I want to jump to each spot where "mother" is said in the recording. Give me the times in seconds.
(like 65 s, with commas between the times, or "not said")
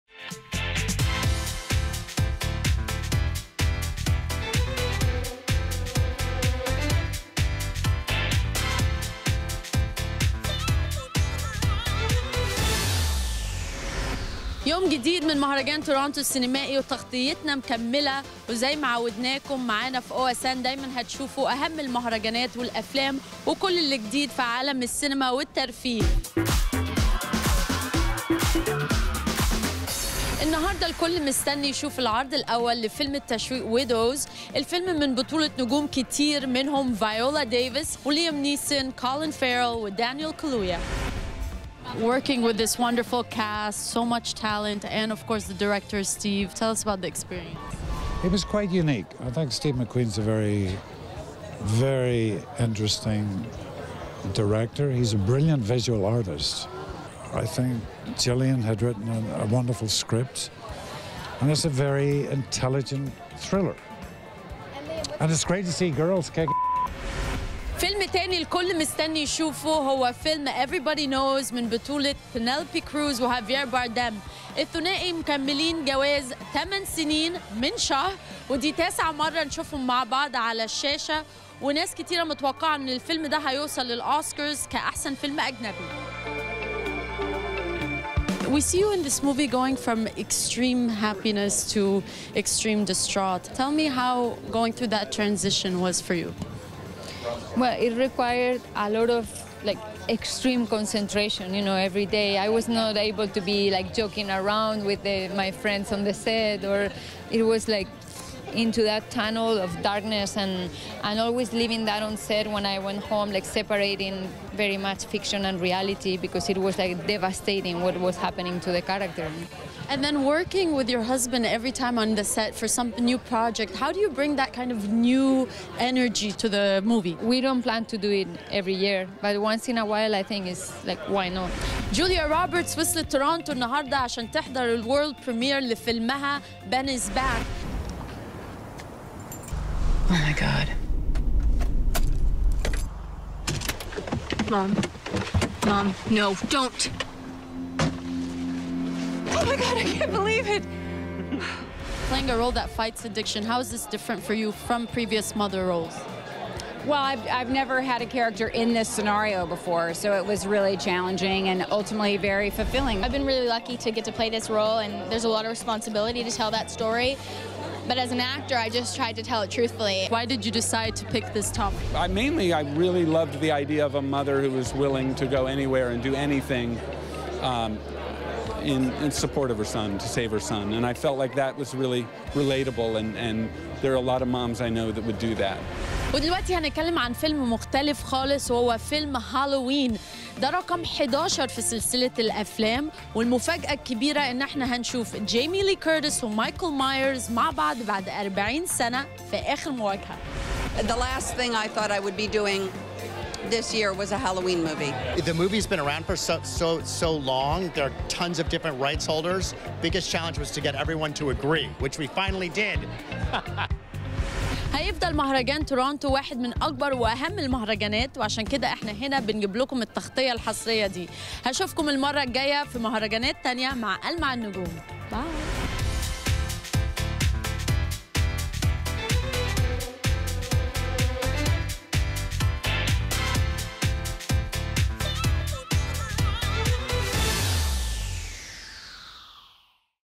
155 s, 174 s.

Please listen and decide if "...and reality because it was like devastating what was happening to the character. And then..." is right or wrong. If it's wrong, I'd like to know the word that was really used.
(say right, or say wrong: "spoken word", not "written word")
right.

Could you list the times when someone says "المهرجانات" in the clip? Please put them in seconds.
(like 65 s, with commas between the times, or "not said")
21 s, 217 s.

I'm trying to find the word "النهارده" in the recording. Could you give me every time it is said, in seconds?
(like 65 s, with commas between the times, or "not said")
30 s, 133 s.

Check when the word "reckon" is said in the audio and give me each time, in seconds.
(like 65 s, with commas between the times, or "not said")
not said.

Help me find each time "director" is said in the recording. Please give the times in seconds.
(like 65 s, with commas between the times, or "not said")
45 s, 54 s.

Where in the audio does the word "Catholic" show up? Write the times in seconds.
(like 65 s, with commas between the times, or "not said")
not said.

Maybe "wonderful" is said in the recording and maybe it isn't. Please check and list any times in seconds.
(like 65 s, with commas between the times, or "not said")
42 s, 59 s.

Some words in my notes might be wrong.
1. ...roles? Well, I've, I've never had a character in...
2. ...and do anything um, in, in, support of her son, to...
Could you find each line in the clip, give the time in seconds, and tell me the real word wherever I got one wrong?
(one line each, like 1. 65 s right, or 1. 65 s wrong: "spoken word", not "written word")
1. 155 s right
2. 175 s right.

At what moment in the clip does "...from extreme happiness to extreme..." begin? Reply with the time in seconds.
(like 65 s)
89 s.